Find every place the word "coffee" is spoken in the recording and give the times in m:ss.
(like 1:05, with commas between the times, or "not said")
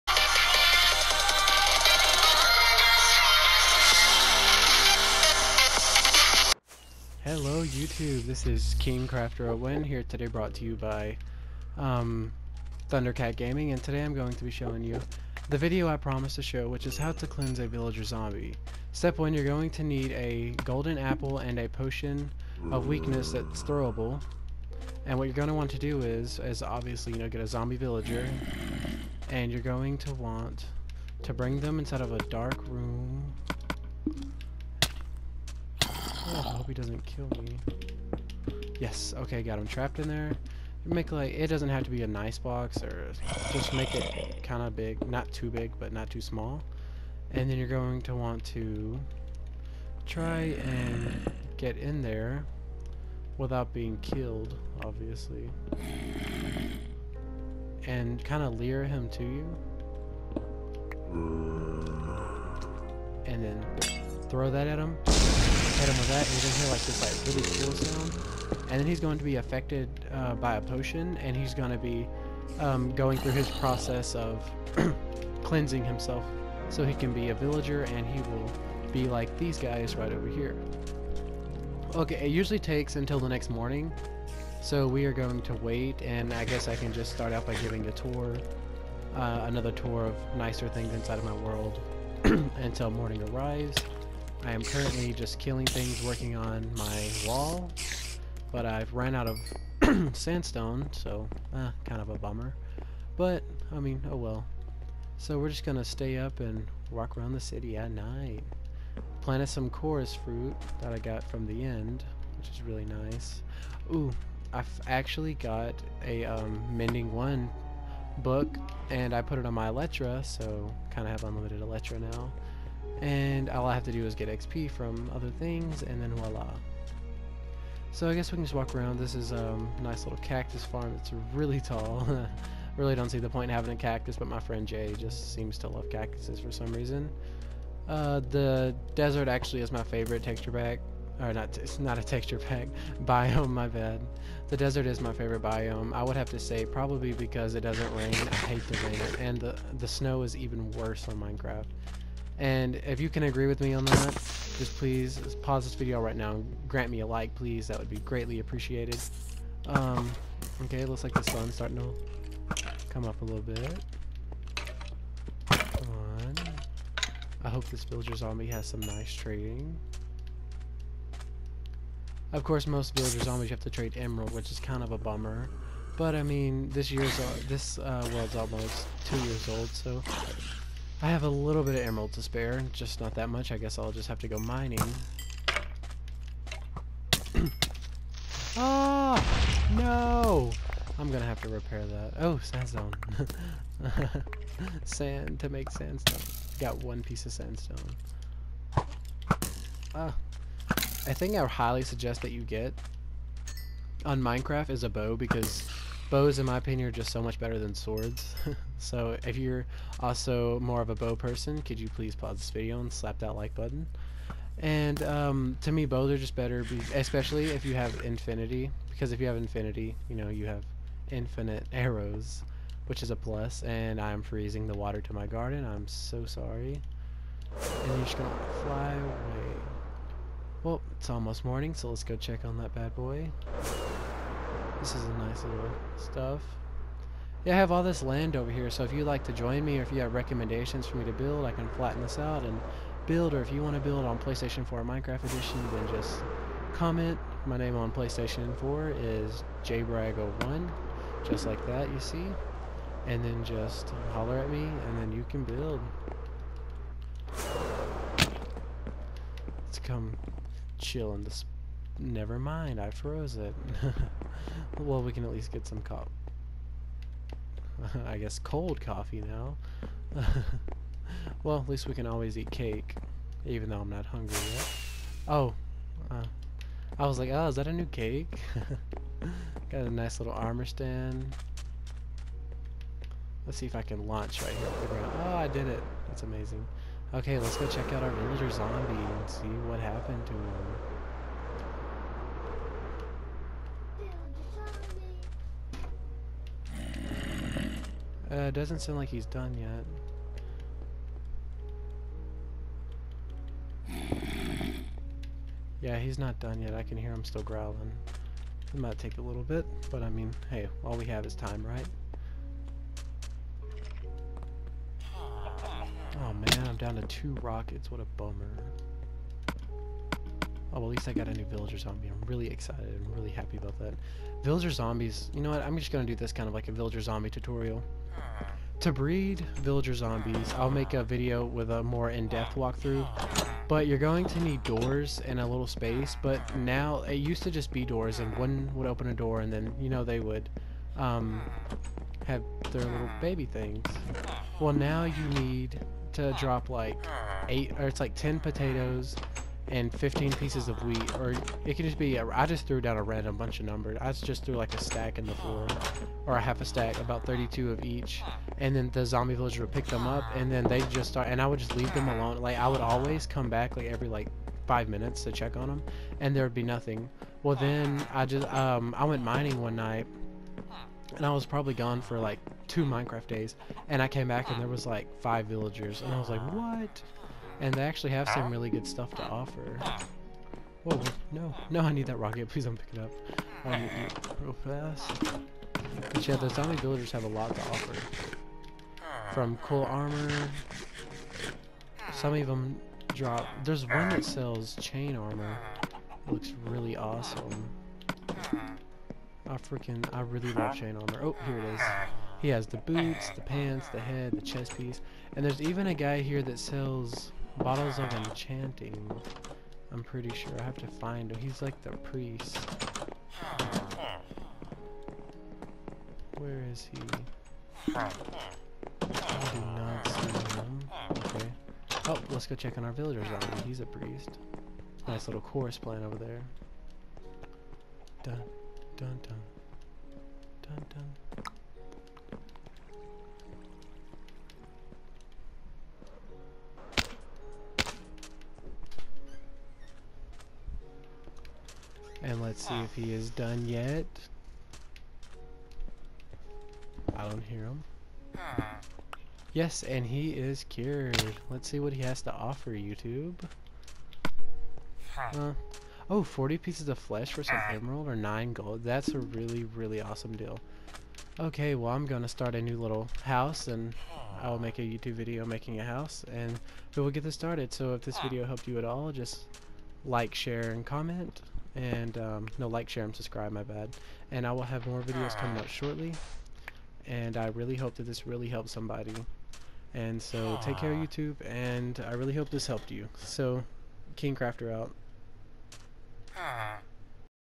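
4:28.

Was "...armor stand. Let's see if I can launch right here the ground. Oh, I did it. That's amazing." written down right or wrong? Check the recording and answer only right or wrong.
right.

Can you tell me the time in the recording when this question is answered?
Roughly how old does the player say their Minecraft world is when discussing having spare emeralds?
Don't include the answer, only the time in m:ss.
2:58.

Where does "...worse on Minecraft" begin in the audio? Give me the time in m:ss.
2:30.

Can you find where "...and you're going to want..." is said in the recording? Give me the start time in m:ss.
0:29.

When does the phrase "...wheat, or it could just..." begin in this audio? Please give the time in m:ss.
5:50.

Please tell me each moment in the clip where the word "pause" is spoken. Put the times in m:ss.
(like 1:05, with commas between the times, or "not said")
2:35, 3:32.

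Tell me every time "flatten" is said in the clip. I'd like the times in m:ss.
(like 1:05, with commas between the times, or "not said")
4:01.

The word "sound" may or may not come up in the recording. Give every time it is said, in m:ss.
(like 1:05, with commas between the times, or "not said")
1:08, 4:58.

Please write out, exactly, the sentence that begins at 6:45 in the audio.
And there's even a guy here that sells Bottles of enchanting.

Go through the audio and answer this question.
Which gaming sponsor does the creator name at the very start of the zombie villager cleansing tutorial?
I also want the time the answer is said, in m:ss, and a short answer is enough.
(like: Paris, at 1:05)
Thundercat Gaming, at 0:12.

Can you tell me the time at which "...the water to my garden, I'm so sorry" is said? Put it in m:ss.
3:44.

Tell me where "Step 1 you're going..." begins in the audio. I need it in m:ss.
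0:18.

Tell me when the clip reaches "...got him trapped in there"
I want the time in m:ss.
0:39.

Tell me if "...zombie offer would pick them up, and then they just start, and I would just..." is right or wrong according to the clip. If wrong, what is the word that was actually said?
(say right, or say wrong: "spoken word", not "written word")
wrong: "villager", not "offer".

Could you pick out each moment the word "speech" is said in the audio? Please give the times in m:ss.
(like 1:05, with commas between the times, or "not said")
not said.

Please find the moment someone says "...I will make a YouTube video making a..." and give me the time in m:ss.
7:44.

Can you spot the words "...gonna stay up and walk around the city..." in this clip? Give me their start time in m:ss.
1:45.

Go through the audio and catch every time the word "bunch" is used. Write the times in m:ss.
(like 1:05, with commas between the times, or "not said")
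5:53.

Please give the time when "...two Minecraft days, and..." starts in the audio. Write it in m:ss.
6:12.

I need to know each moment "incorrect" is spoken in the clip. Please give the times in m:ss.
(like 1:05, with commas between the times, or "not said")
not said.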